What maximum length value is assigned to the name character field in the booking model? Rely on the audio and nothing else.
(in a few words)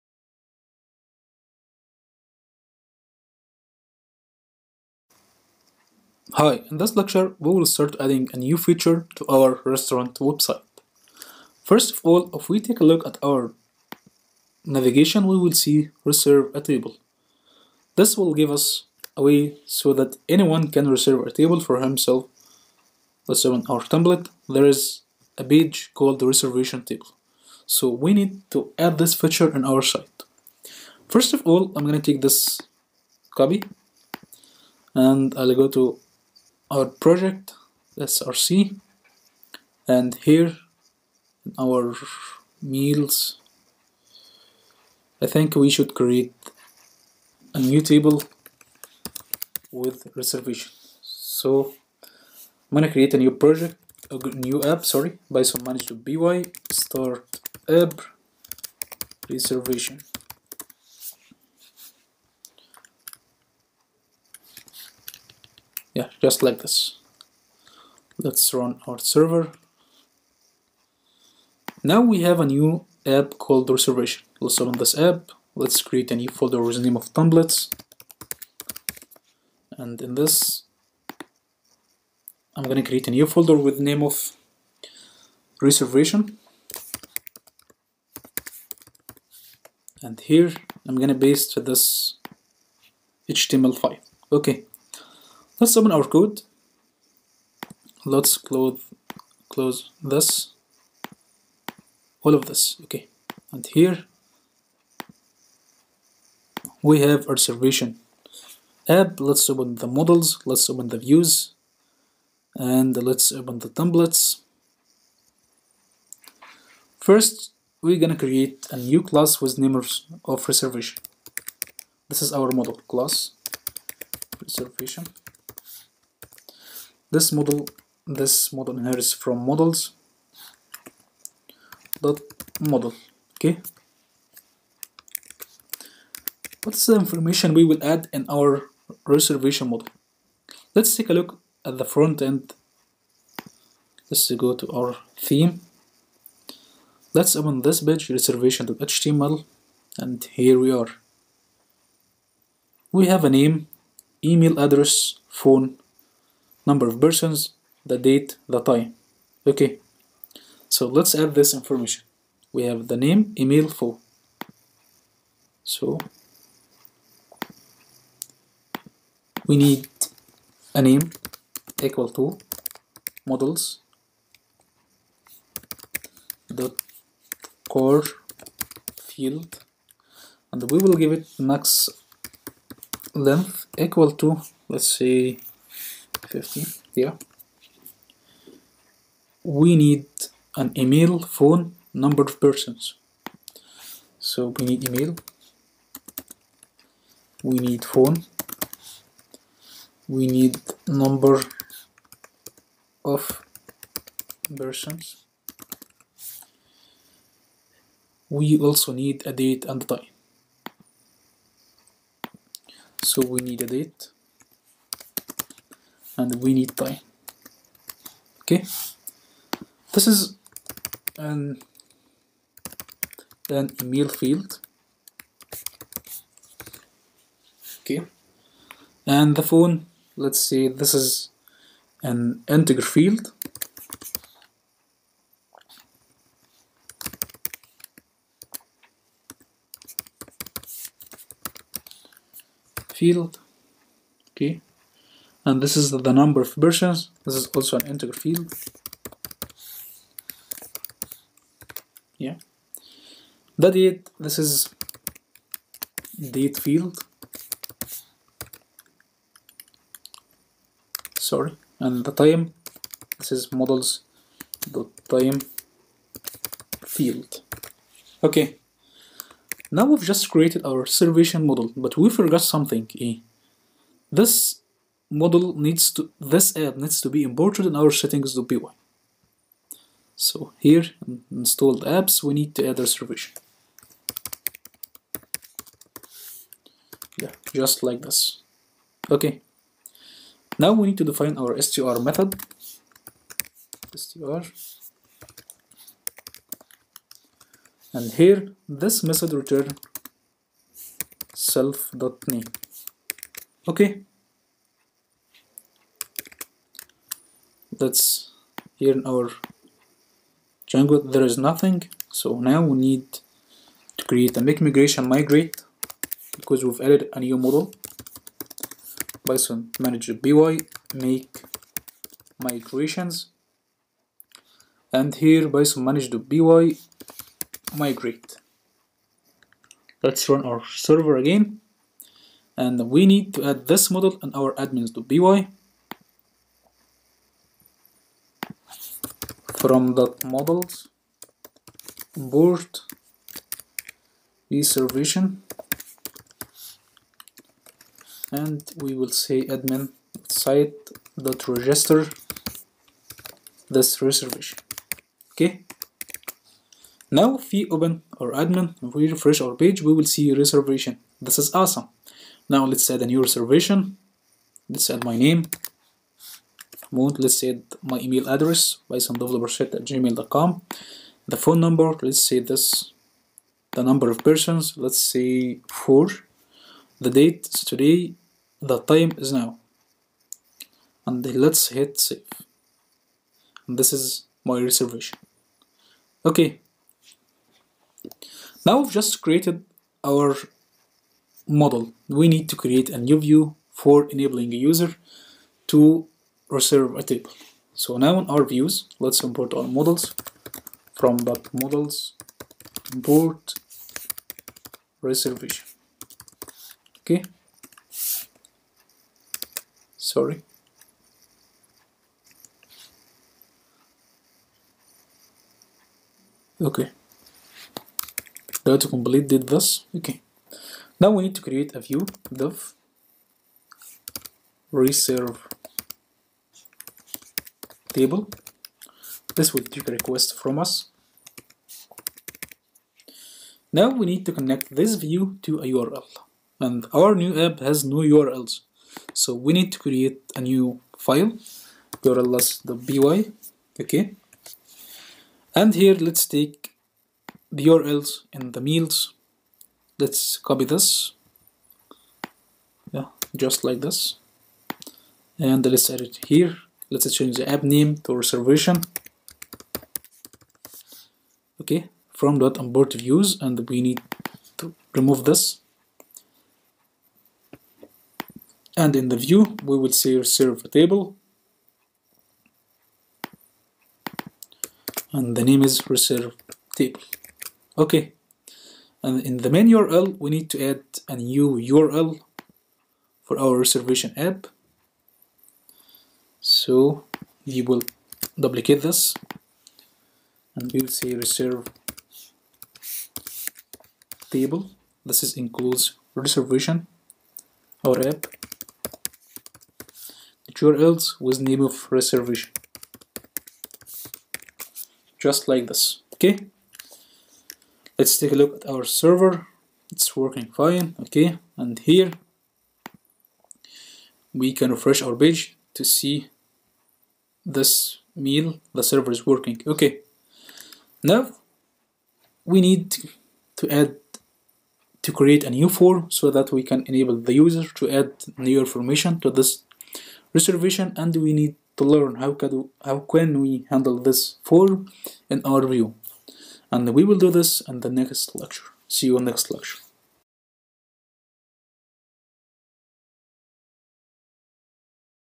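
15.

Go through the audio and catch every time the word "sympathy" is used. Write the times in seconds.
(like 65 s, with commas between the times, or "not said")
not said.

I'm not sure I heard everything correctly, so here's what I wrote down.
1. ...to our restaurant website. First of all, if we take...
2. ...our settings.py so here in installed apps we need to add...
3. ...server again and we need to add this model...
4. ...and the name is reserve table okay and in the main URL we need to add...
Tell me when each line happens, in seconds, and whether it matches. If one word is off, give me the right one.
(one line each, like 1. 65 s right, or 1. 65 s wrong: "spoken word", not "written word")
1. 9 s right
2. 277 s right
3. 330 s right
4. 475 s right.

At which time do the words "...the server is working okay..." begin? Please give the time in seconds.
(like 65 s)
518 s.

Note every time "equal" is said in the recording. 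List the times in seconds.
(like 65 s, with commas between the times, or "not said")
171 s, 183 s.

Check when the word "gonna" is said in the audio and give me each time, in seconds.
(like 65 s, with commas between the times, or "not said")
31 s, 52 s, 82 s, 91 s, 118 s.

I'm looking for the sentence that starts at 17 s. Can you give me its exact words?
This will give us a way so that anyone can reserve a table for himself.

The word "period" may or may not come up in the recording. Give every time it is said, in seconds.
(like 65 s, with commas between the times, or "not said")
not said.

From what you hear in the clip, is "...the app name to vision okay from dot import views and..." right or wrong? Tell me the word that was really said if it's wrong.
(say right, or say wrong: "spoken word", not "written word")
wrong: "reservation", not "vision".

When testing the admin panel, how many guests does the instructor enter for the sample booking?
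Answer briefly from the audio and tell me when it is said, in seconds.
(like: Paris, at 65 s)
4, at 375 s.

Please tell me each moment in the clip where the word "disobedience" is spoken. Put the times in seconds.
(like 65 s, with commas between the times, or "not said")
not said.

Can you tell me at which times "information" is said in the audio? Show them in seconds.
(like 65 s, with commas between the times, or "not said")
136 s, 161 s, 528 s.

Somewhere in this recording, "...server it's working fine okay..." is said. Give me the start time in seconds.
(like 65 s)
508 s.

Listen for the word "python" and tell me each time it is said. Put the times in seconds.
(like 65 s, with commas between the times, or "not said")
319 s, 325 s.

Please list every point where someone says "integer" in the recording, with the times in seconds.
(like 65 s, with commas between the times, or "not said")
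232 s, 247 s.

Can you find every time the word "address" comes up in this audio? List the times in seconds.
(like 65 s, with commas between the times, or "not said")
154 s, 368 s.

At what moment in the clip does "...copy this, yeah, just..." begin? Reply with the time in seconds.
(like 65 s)
450 s.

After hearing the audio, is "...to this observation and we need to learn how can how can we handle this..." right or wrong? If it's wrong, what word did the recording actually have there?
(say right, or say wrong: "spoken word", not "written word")
wrong: "reservation", not "observation".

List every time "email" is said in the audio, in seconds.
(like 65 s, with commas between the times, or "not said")
154 s, 163 s, 190 s, 194 s, 223 s, 367 s.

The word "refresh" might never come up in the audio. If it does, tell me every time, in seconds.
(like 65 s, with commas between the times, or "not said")
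359 s, 514 s.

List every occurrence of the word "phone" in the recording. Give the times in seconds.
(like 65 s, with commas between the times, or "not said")
155 s, 191 s, 197 s, 229 s, 371 s.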